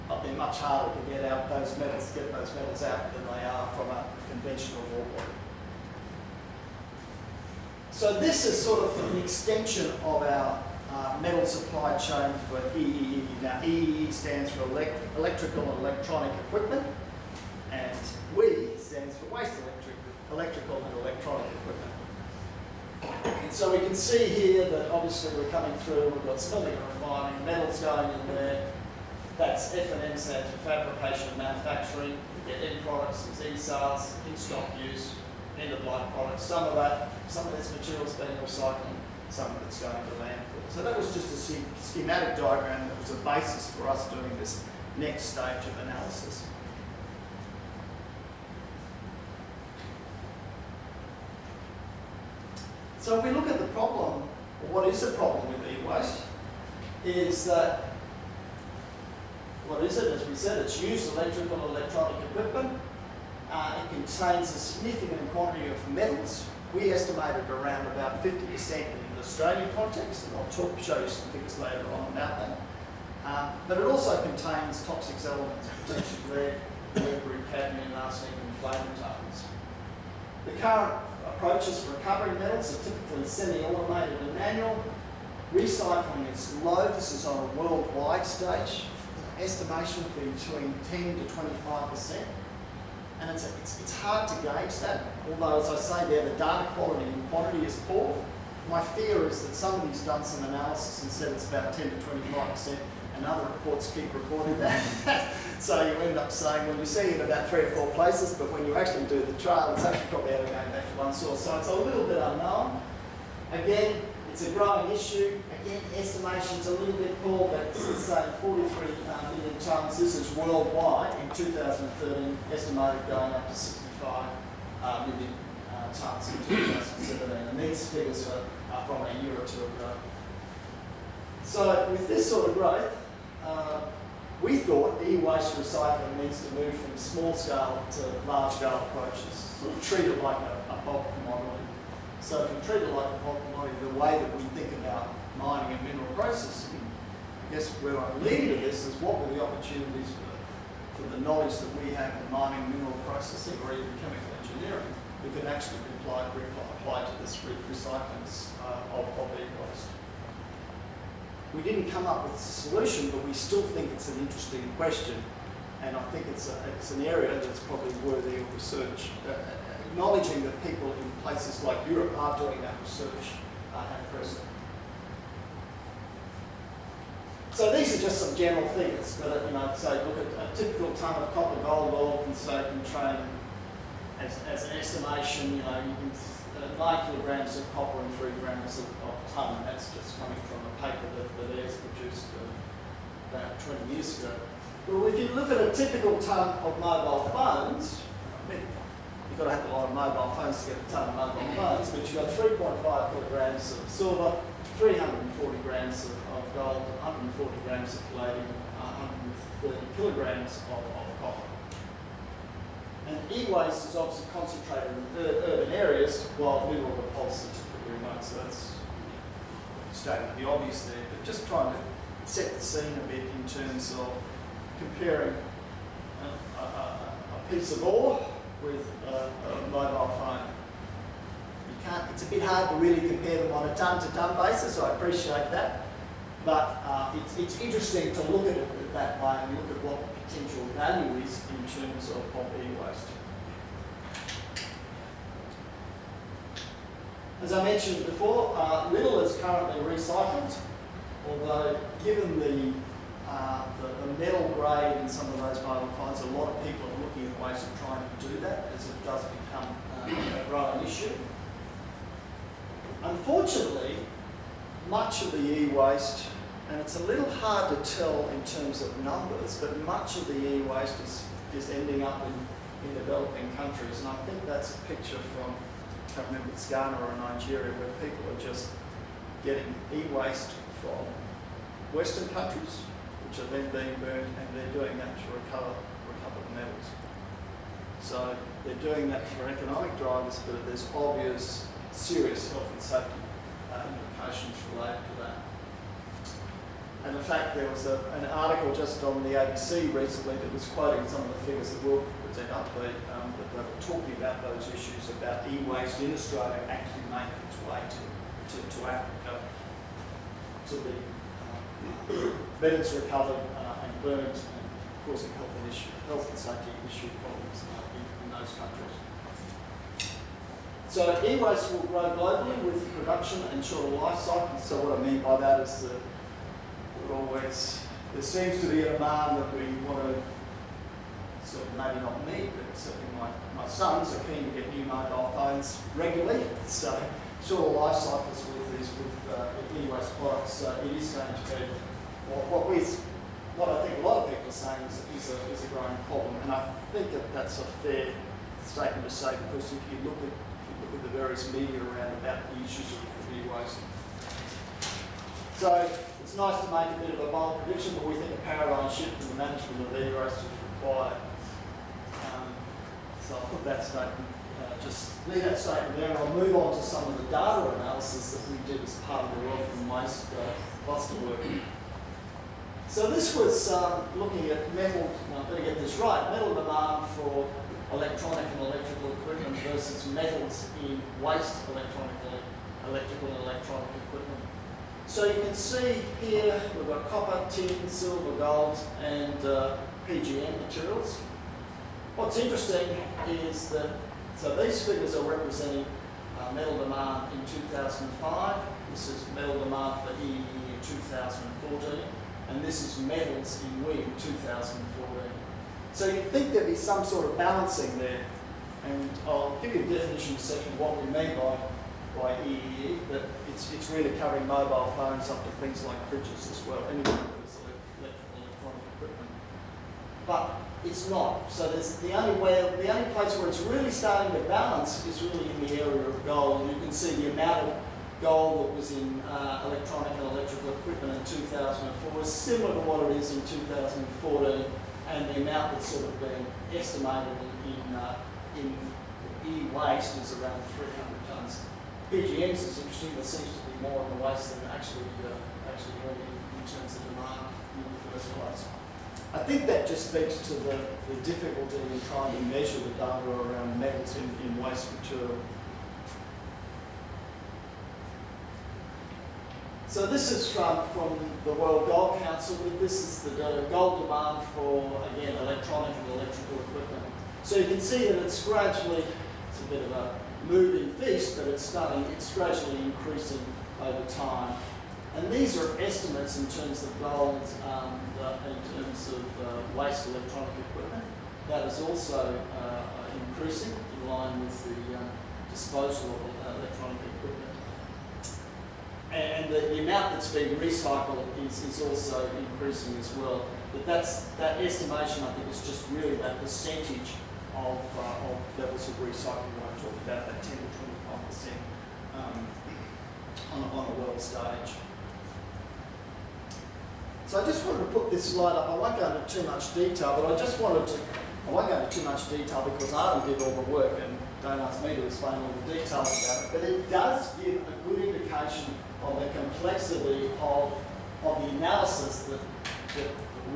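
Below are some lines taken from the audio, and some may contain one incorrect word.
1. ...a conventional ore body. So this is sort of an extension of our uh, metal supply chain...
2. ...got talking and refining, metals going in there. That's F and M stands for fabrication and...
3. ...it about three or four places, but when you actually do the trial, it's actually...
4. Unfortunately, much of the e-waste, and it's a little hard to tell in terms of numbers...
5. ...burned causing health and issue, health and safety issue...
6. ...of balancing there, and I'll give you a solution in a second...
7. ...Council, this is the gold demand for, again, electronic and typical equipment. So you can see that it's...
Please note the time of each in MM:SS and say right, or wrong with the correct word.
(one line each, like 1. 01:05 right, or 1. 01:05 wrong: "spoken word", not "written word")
1. 00:03 right
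2. 00:26 wrong: "smelting", not "talking"
3. 01:47 right
4. 04:23 right
5. 05:14 right
6. 06:47 wrong: "definition", not "solution"
7. 07:42 wrong: "electrical", not "typical".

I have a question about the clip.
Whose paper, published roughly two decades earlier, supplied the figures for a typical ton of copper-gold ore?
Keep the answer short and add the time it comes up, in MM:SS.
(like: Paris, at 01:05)
Ayres, at 03:11.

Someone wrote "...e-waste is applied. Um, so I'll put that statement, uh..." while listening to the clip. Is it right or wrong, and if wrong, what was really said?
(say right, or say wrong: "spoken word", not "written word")
wrong: "required", not "applied".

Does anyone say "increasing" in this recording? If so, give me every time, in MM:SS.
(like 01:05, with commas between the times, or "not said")
07:52, 08:03, 08:12.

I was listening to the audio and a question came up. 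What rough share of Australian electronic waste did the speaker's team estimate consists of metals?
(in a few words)
50%.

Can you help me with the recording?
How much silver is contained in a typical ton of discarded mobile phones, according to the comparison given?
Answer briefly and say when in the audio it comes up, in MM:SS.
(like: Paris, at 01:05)
3.5 kilograms, at 03:23.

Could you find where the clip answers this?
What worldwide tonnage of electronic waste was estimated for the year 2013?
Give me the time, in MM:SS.
01:58.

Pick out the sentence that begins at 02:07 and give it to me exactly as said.
And these figures are, are from a year or two ago.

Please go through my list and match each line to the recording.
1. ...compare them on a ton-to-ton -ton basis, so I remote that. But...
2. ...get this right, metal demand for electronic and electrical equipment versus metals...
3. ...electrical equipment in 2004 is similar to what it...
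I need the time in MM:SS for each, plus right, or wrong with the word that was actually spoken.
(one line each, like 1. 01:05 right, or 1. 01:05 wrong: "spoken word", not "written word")
1. 03:53 wrong: "appreciate", not "remote"
2. 06:15 right
3. 07:10 right.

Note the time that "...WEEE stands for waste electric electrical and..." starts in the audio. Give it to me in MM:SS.
00:18.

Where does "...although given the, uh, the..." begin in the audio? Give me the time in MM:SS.
04:11.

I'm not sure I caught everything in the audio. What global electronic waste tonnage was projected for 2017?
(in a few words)
65 million tonnes.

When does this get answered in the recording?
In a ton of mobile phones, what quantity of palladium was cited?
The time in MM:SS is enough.
03:27.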